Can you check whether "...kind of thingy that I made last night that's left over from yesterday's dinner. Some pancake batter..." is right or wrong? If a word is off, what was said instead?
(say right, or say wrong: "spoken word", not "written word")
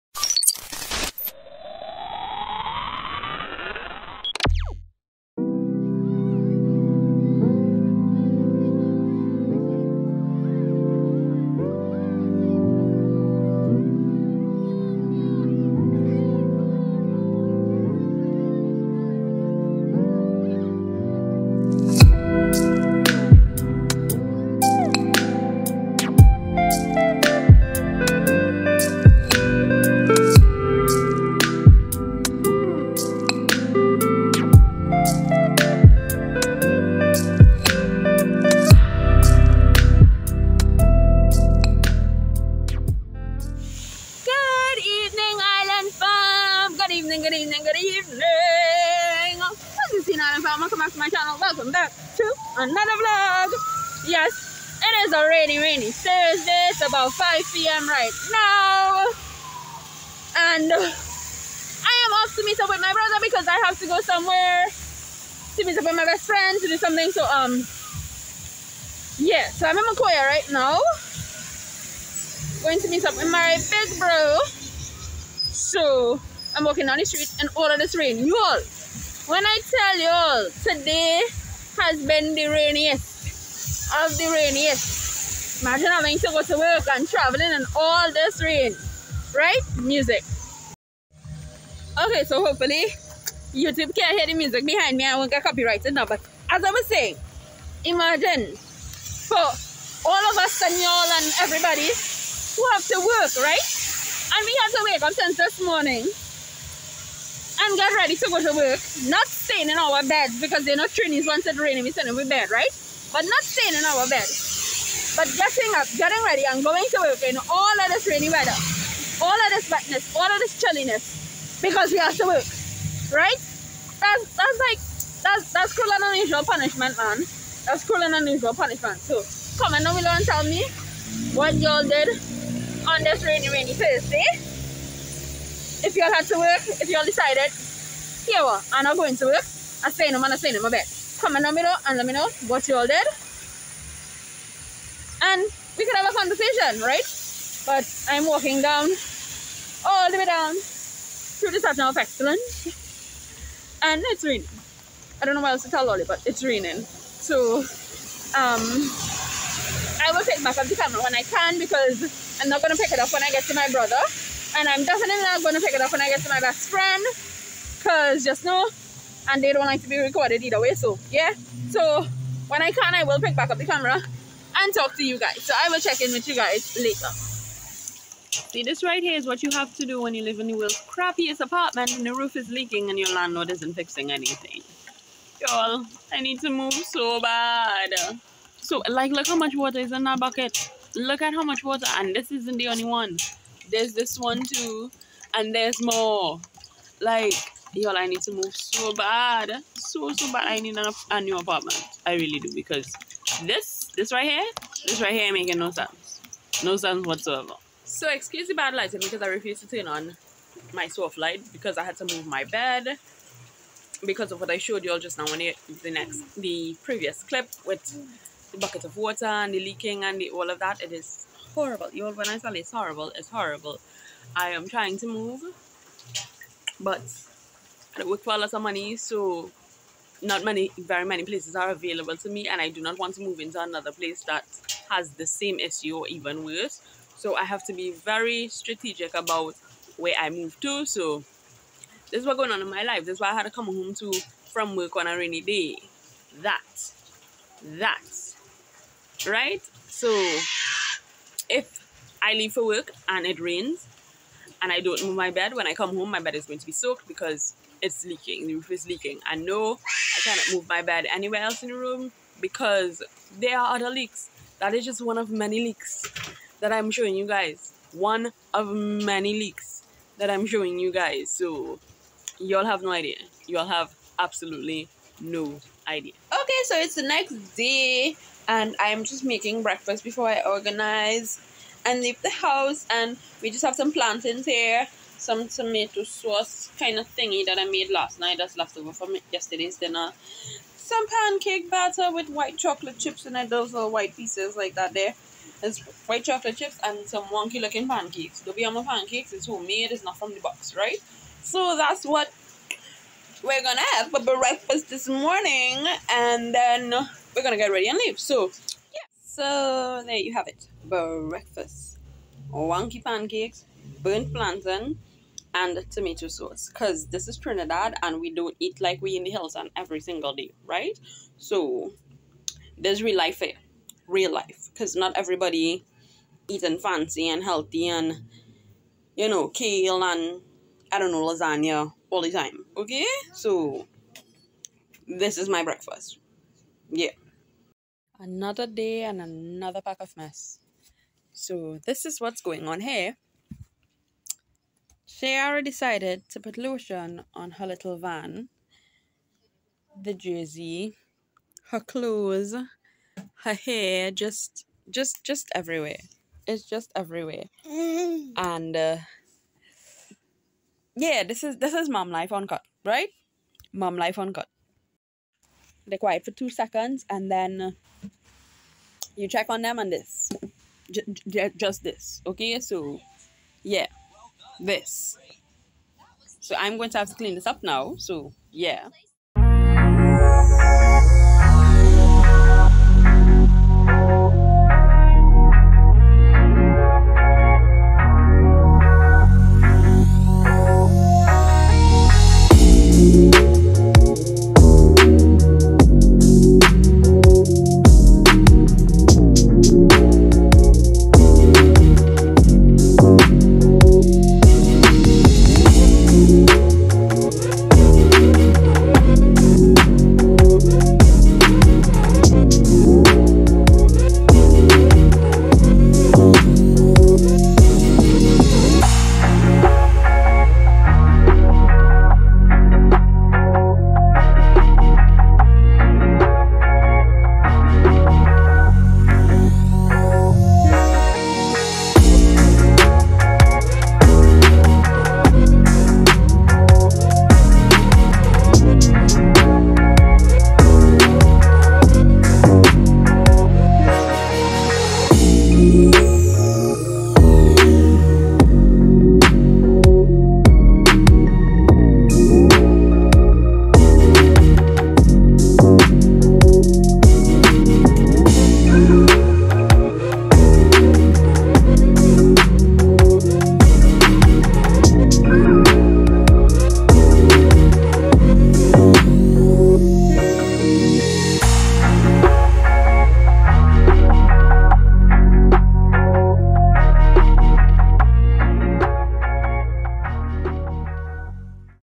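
right.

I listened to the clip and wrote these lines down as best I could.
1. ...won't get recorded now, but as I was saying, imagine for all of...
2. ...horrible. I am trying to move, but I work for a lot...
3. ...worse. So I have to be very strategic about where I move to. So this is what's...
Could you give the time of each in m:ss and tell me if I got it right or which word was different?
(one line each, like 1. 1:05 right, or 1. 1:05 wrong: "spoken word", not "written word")
1. 1:35 wrong: "copyrighted", not "recorded"
2. 3:43 right
3. 3:56 right.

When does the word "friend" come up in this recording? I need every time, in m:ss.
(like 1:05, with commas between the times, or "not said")
1:06, 2:46.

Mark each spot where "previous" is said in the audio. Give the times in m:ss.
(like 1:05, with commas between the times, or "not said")
3:36.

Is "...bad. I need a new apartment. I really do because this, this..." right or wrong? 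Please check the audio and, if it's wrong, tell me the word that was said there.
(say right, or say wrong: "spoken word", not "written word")
right.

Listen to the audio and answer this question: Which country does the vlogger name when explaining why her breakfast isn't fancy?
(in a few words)
Trinidad.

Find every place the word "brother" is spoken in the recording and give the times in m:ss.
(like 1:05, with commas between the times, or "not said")
1:02, 2:43.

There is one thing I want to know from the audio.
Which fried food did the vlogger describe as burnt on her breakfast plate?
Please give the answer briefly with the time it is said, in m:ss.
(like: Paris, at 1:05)
Plantain, at 5:14.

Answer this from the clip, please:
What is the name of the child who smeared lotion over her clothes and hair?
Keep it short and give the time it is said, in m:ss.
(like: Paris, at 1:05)
Shayara, at 5:45.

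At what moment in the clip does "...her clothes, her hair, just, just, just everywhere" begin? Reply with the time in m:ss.
5:51.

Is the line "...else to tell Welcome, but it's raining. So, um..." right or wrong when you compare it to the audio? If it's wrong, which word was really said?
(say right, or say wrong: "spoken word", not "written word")
wrong: "Lolly", not "Welcome".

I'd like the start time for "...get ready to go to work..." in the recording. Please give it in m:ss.
1:47.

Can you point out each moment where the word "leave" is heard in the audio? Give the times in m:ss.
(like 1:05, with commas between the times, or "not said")
4:12, 4:42, 5:07.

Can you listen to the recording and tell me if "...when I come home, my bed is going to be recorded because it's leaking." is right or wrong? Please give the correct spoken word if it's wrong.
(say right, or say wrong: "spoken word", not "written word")
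wrong: "soaked", not "recorded".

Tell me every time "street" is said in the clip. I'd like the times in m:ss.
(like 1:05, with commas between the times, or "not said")
1:17.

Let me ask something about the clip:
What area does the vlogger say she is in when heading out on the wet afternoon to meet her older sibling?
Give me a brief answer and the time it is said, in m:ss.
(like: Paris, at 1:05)
Macoya, at 1:09.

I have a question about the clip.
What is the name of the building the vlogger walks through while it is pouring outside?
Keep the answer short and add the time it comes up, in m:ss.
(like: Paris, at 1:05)
Centre of Excellence, at 2:31.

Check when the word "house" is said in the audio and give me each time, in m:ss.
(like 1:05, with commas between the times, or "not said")
4:42.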